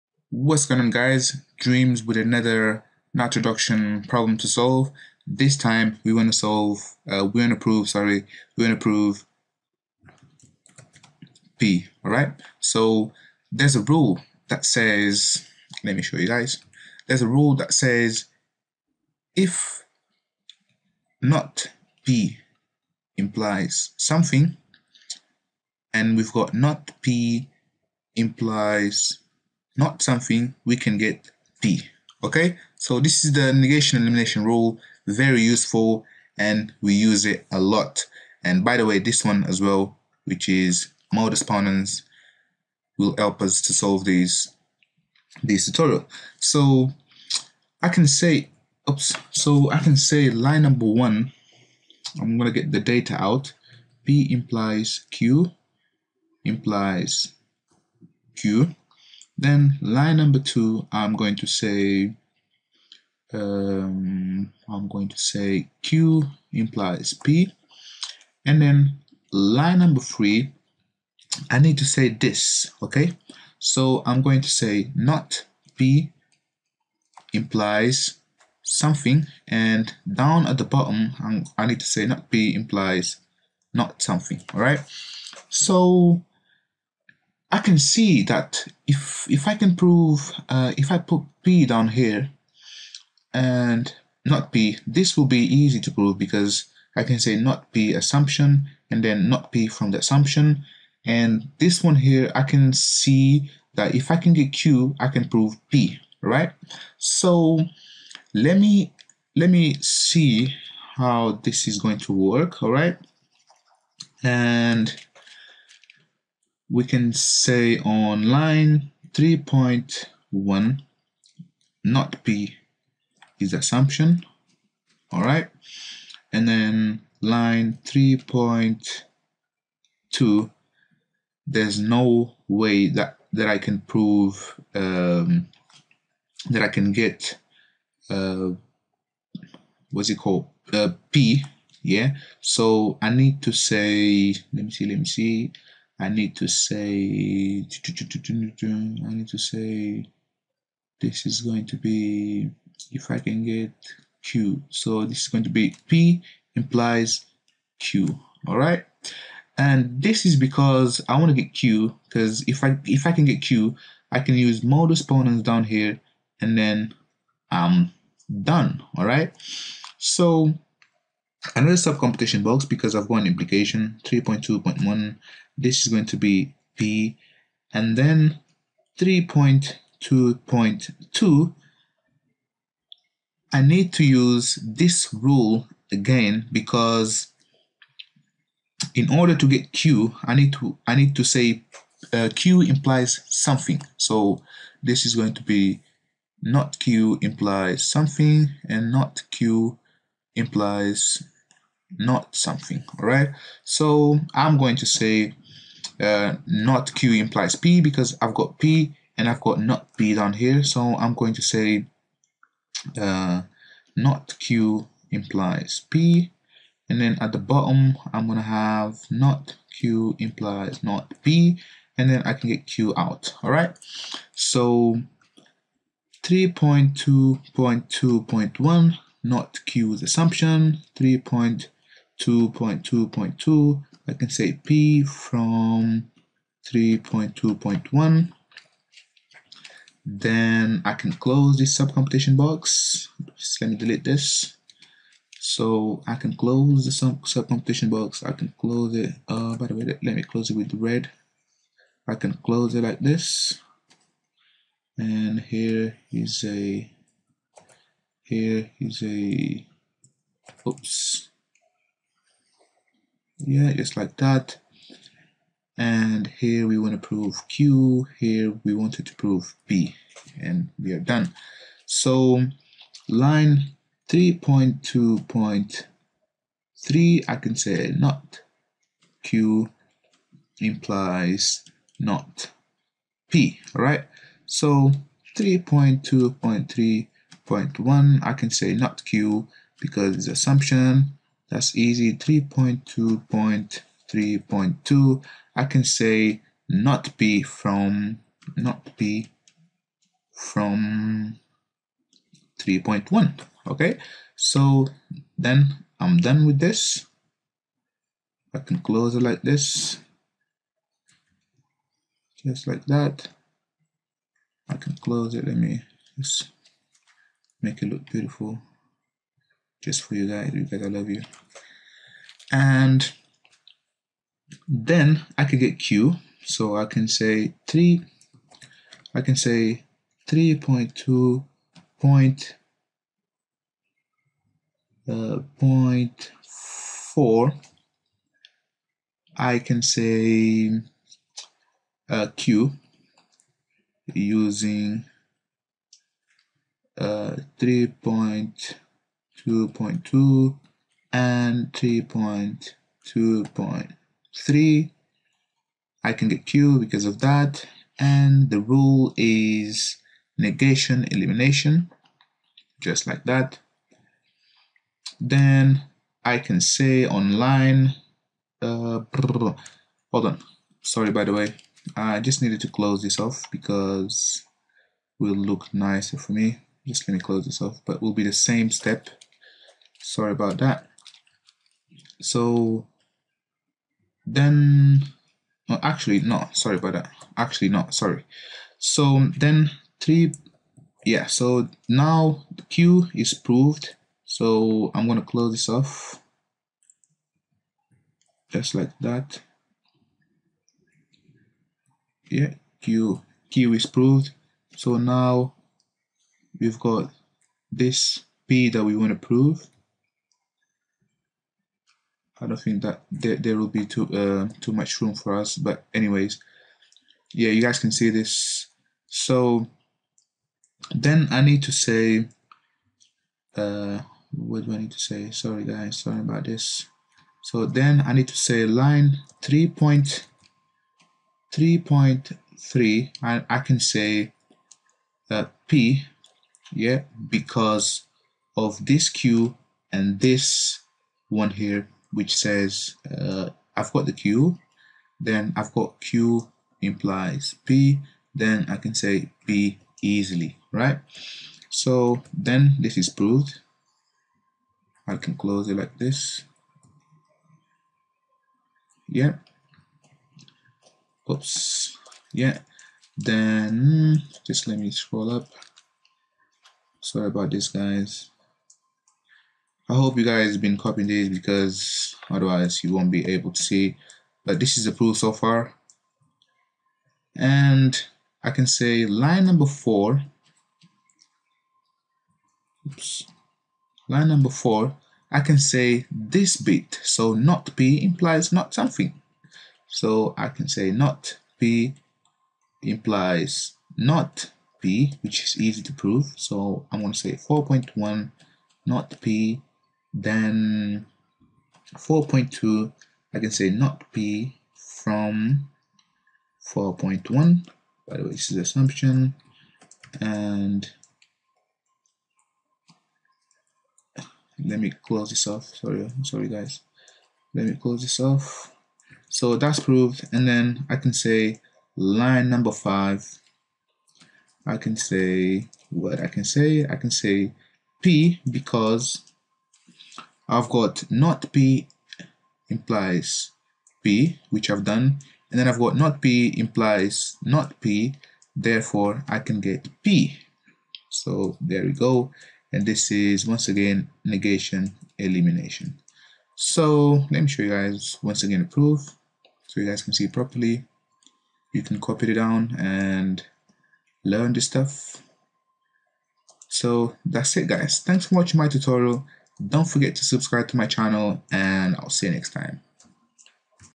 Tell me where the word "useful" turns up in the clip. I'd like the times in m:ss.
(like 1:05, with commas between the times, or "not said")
0:35.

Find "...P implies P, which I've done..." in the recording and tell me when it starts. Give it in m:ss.
8:51.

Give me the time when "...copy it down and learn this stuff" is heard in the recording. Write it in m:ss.
9:12.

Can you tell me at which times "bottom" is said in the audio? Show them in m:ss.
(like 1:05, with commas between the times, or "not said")
1:20, 3:37.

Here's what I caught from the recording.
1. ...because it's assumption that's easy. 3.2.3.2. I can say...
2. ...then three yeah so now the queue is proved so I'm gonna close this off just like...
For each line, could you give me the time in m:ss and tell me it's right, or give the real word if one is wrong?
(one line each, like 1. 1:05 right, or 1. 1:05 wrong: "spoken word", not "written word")
1. 4:49 right
2. 6:29 right.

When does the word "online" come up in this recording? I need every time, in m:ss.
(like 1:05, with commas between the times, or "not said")
6:07.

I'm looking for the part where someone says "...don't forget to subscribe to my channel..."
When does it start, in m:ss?
9:19.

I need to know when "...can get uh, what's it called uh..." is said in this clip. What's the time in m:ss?
2:16.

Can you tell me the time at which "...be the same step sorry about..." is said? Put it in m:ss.
6:18.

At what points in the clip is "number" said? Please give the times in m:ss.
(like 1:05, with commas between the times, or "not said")
0:50, 1:00, 1:09, 7:59, 8:04, 8:42.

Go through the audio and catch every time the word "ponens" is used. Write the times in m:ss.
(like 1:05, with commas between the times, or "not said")
0:41, 2:45.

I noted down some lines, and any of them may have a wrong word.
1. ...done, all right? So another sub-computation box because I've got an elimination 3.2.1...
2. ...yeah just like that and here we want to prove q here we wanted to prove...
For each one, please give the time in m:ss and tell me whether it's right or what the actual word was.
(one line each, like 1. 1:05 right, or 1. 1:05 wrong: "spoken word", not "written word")
1. 2:48 wrong: "implication", not "elimination"
2. 4:23 right.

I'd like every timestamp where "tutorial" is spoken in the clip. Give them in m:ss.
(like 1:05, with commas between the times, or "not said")
0:45, 9:18.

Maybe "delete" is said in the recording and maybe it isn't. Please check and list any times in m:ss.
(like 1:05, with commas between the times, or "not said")
4:03.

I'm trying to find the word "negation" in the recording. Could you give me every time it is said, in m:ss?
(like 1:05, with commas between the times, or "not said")
0:33, 6:00, 9:04.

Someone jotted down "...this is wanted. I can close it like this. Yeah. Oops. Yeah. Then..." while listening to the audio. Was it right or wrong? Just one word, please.
wrong.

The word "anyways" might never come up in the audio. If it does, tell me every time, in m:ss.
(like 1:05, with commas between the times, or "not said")
6:55.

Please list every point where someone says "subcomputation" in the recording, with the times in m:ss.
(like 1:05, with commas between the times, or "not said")
4:01, 4:07.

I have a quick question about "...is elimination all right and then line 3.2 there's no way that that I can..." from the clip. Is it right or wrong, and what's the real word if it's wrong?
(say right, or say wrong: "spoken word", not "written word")
wrong: "assumption", not "elimination".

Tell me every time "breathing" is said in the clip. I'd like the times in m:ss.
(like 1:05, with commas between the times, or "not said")
not said.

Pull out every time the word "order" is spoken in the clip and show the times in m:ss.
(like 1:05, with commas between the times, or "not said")
3:09.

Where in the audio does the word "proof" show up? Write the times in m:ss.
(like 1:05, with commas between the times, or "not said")
7:54, 9:08.